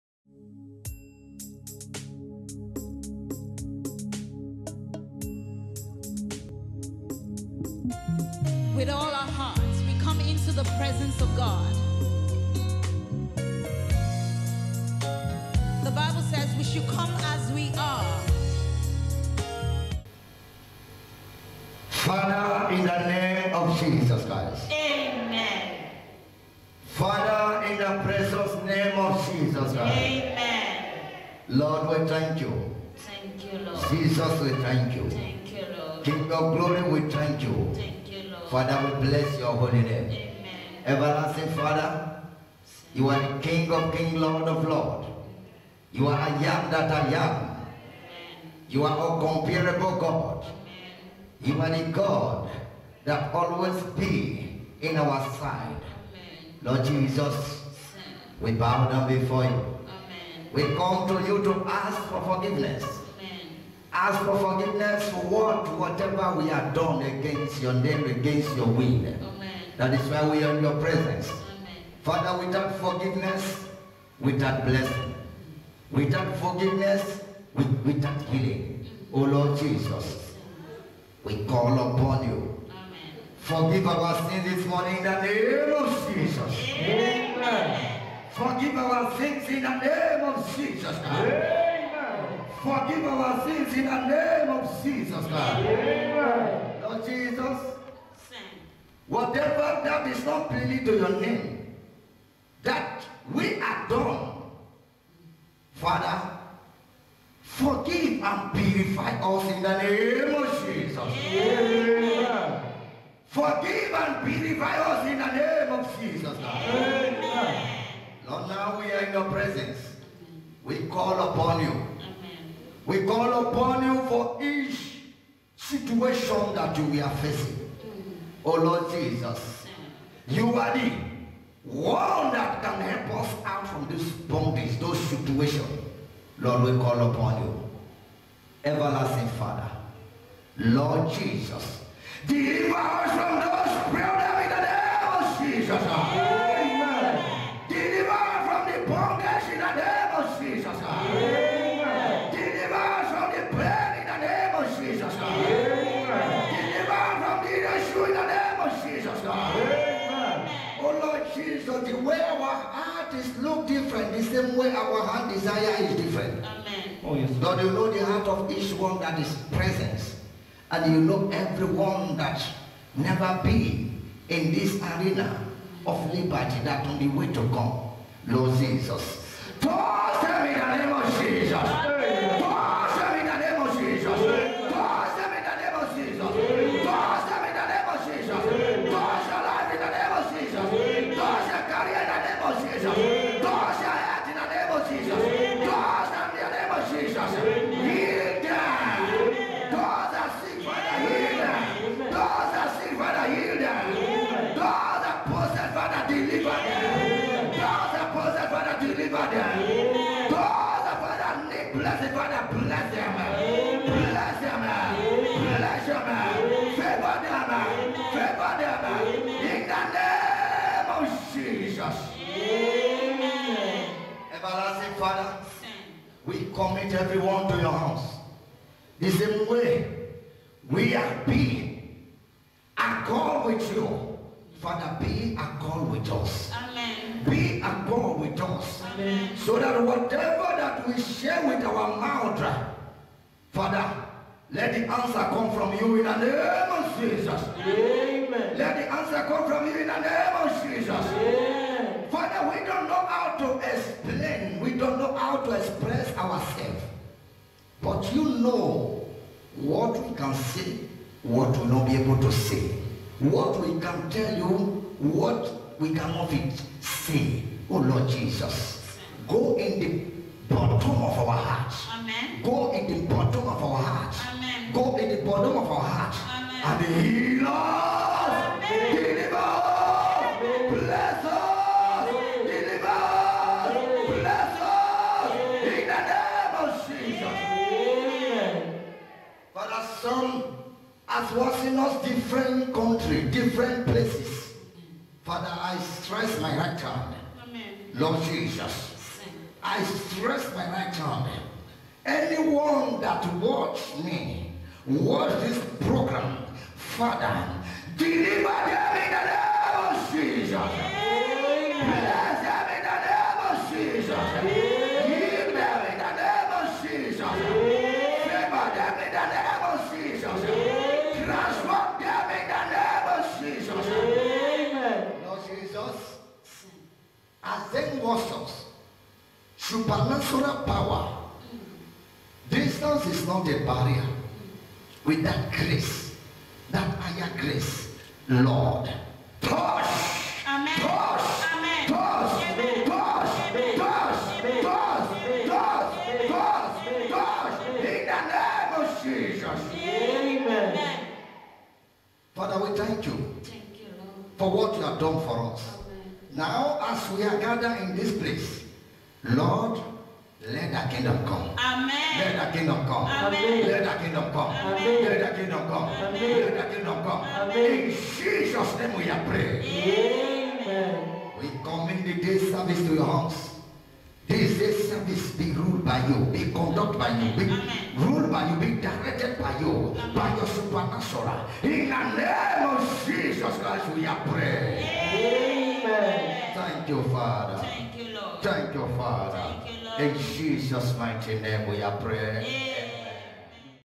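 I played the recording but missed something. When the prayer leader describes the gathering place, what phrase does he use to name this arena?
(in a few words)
arena of liberty.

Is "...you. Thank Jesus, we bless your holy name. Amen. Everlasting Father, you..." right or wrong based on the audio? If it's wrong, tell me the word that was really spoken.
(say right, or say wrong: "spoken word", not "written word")
wrong: "Father", not "Jesus".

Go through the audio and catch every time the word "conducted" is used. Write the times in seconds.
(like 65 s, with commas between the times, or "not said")
376 s.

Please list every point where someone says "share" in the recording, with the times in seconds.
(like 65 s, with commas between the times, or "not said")
241 s.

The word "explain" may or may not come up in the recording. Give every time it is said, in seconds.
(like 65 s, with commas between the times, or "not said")
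253 s.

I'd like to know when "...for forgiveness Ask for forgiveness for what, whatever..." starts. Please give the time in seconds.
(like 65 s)
62 s.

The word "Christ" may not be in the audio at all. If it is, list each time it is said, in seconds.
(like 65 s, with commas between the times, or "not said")
24 s, 29 s, 383 s.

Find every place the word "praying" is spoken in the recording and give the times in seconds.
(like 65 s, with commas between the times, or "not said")
369 s, 384 s, 391 s.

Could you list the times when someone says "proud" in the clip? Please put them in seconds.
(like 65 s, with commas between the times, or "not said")
not said.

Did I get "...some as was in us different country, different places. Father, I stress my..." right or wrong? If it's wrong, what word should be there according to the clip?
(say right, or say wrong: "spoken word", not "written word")
right.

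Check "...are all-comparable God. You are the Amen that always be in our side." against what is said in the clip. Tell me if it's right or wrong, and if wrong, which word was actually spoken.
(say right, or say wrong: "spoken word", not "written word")
wrong: "God", not "Amen".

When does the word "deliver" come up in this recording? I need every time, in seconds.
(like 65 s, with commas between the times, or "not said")
142 s, 278 s.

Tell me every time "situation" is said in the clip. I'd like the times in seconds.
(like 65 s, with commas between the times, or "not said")
125 s, 134 s.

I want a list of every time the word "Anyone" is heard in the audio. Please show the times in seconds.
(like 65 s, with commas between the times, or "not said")
302 s.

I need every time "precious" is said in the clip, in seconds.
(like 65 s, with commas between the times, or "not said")
28 s.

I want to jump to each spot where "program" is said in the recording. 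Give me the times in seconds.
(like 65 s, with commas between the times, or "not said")
305 s.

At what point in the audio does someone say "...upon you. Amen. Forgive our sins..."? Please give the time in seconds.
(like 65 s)
81 s.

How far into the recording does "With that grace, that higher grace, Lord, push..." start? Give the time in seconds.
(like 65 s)
335 s.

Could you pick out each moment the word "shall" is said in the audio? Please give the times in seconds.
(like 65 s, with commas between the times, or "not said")
not said.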